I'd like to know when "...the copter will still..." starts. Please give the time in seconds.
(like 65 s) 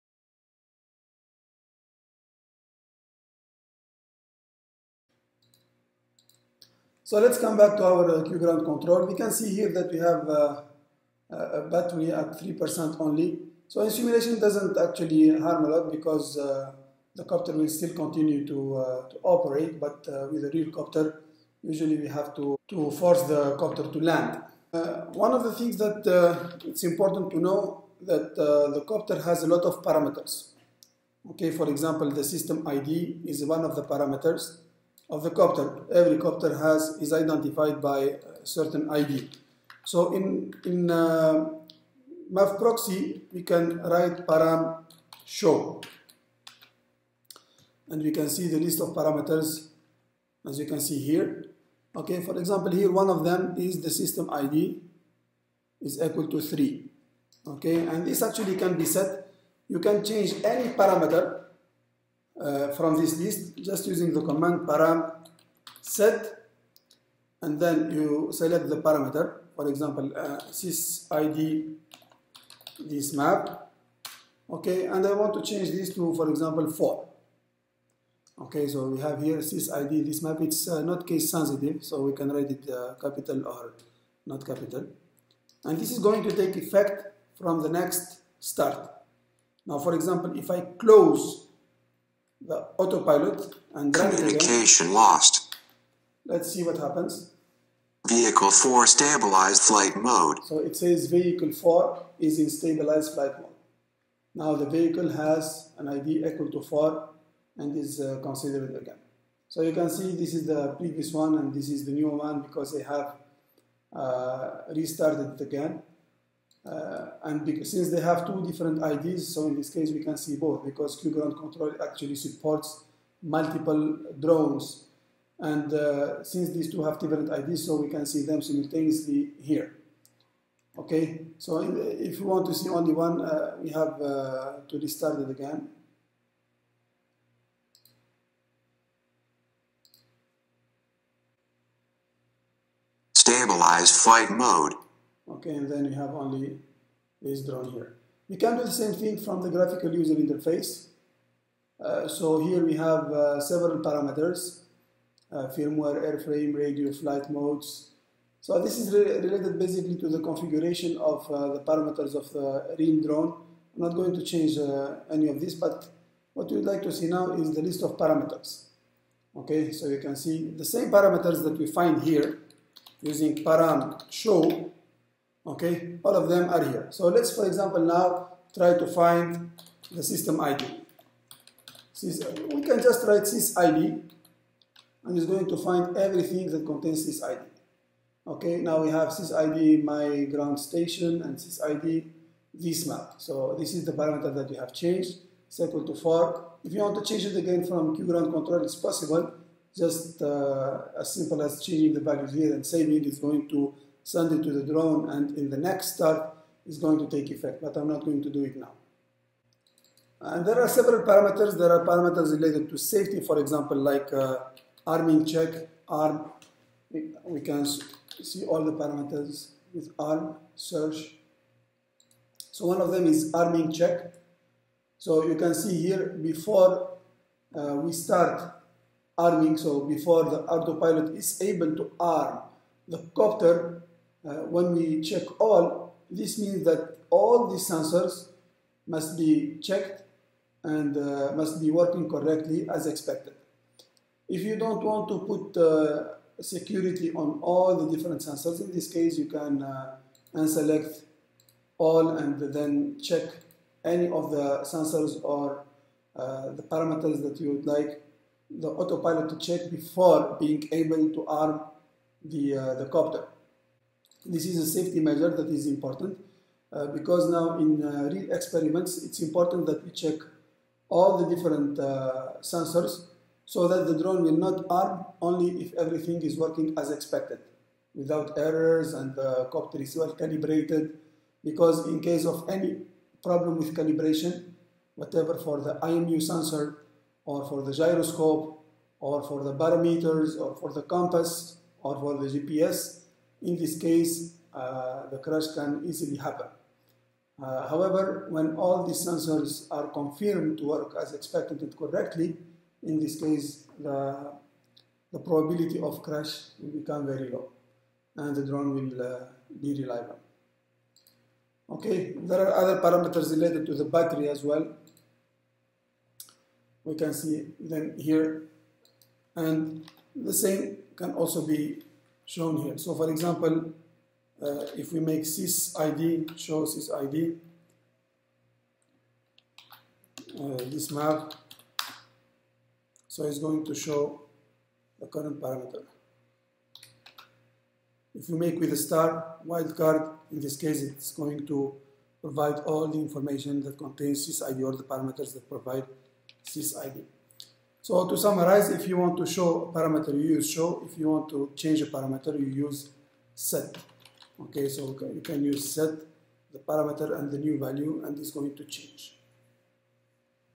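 17 s.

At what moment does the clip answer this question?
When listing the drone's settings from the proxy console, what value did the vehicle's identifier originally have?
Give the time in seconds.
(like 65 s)
56 s.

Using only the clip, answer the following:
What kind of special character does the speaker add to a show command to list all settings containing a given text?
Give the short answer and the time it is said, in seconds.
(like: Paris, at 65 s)
star wildcard, at 338 s.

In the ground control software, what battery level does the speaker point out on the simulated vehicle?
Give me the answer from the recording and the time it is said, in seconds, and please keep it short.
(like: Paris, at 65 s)
3%, at 12 s.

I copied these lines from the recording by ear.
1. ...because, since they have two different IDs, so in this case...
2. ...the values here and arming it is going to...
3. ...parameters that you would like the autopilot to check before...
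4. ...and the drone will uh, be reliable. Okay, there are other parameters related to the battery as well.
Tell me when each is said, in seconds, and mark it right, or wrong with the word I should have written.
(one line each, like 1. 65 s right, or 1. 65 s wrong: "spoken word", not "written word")
1. 117 s right
2. 201 s wrong: "saving", not "arming"
3. 256 s right
4. 308 s right.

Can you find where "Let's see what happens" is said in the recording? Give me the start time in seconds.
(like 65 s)
96 s.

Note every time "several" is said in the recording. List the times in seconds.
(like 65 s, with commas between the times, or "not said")
153 s, 210 s.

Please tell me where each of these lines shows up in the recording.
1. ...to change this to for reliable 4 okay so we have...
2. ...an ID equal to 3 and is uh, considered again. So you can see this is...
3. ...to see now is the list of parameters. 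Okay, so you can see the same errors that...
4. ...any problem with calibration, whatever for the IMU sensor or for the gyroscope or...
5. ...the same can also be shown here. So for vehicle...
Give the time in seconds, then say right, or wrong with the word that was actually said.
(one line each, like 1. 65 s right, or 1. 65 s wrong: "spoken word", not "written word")
1. 75 s wrong: "example", not "reliable"
2. 105 s wrong: "4", not "3"
3. 166 s wrong: "parameters", not "errors"
4. 282 s right
5. 320 s wrong: "example", not "vehicle".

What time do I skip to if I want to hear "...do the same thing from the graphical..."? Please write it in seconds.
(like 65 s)
148 s.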